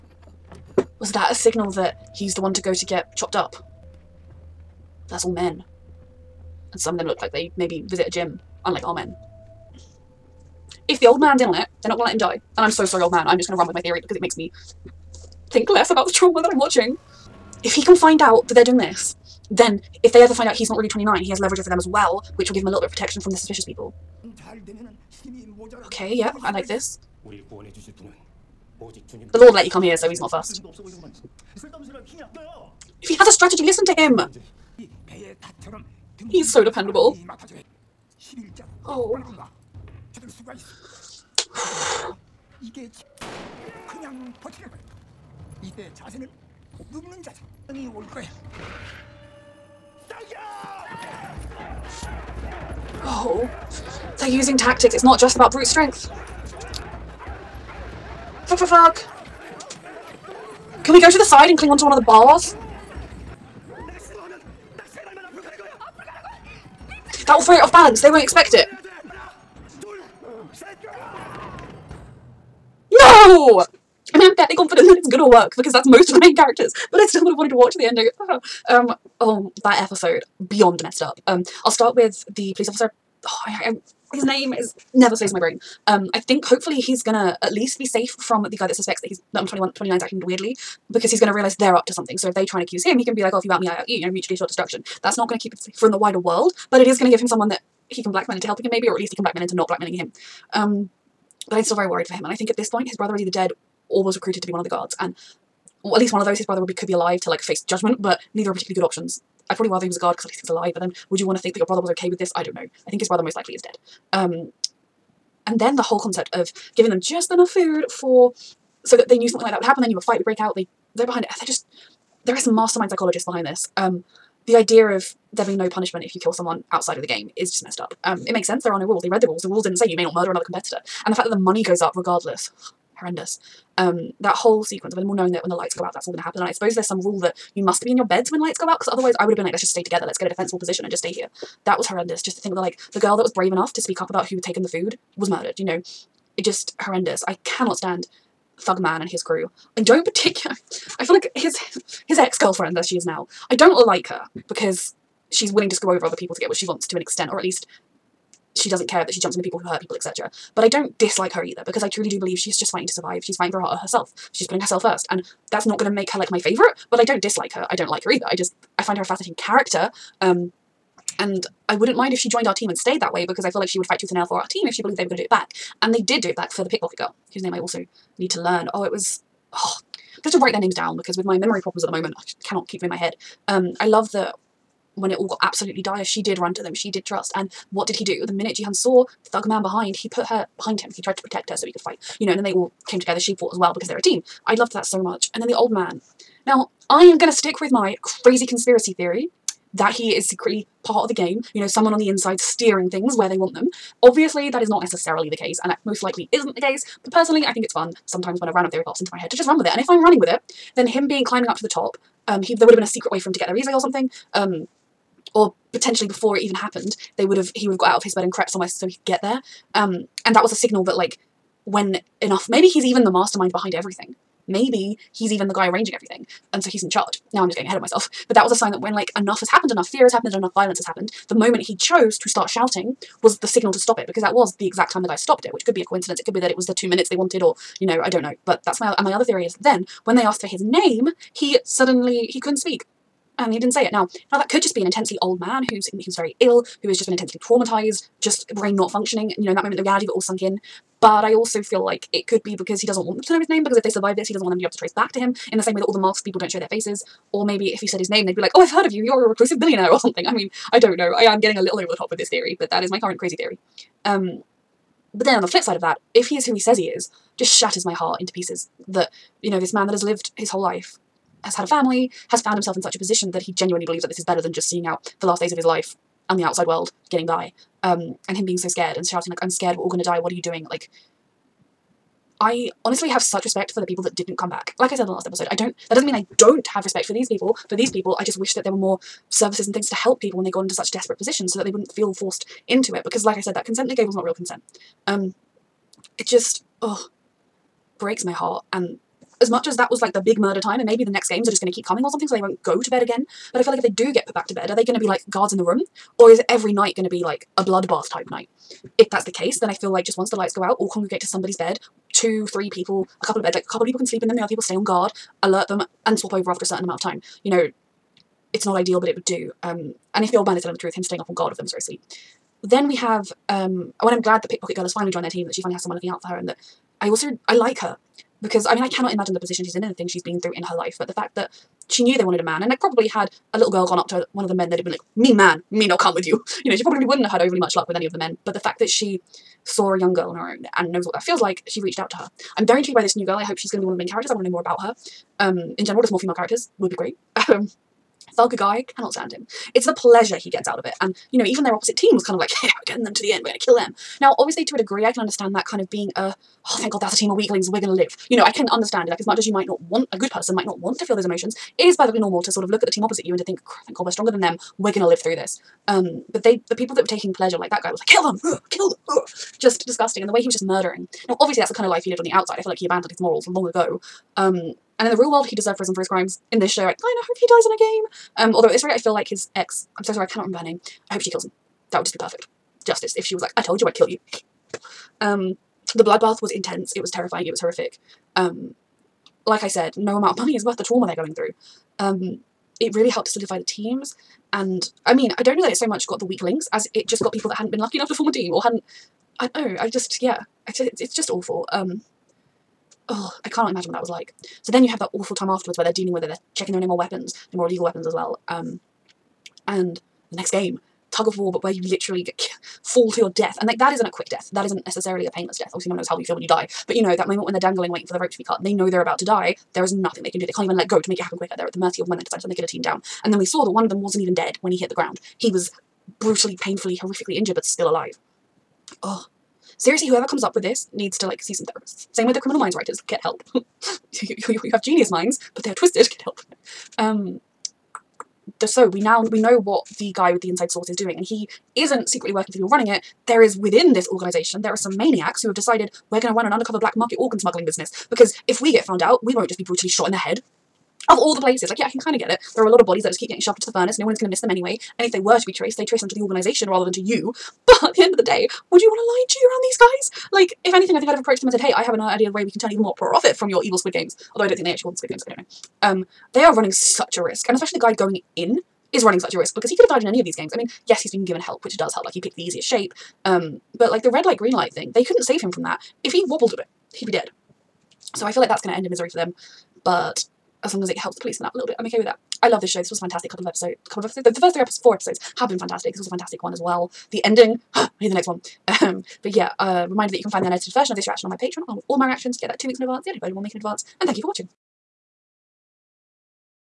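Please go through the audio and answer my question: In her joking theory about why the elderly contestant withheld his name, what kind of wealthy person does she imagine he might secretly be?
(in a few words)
A reclusive billionaire.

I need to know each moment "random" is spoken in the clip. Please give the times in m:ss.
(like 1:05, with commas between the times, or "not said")
3:28.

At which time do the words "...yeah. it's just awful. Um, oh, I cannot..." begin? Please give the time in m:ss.
6:40.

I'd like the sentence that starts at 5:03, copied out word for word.
But I feel like if they do get put back to bed, are they going to be like guards in the room?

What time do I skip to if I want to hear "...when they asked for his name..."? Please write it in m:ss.
4:00.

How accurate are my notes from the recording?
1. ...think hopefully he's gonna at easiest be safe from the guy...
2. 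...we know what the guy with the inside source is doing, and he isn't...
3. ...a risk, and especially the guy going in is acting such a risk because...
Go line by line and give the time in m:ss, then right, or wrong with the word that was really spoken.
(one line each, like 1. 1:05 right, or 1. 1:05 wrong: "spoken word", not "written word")
1. 1:26 wrong: "least", not "easiest"
2. 7:19 right
3. 7:47 wrong: "running", not "acting".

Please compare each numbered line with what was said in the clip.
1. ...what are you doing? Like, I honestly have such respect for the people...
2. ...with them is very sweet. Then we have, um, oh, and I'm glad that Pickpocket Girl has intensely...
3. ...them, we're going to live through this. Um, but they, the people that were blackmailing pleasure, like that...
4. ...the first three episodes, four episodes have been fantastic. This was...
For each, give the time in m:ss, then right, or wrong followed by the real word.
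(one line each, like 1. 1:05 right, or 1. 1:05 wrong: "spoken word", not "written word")
1. 4:40 right
2. 5:21 wrong: "finally", not "intensely"
3. 6:04 wrong: "taking", not "blackmailing"
4. 8:04 right.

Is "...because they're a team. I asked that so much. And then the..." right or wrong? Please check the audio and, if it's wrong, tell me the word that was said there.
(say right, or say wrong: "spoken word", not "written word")
wrong: "loved", not "asked".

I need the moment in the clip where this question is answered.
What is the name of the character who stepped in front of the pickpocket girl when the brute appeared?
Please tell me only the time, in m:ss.
3:08.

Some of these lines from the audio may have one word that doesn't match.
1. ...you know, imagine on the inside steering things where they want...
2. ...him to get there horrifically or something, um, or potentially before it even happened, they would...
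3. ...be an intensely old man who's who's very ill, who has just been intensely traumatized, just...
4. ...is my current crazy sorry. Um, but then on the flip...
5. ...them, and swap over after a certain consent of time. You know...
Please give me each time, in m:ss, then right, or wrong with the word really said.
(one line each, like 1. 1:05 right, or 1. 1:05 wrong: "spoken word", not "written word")
1. 3:21 wrong: "someone", not "imagine"
2. 3:33 wrong: "easily", not "horrifically"
3. 4:04 right
4. 4:22 wrong: "theory", not "sorry"
5. 5:15 wrong: "amount", not "consent".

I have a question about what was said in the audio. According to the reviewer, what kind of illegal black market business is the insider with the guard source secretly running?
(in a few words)
Organ smuggling.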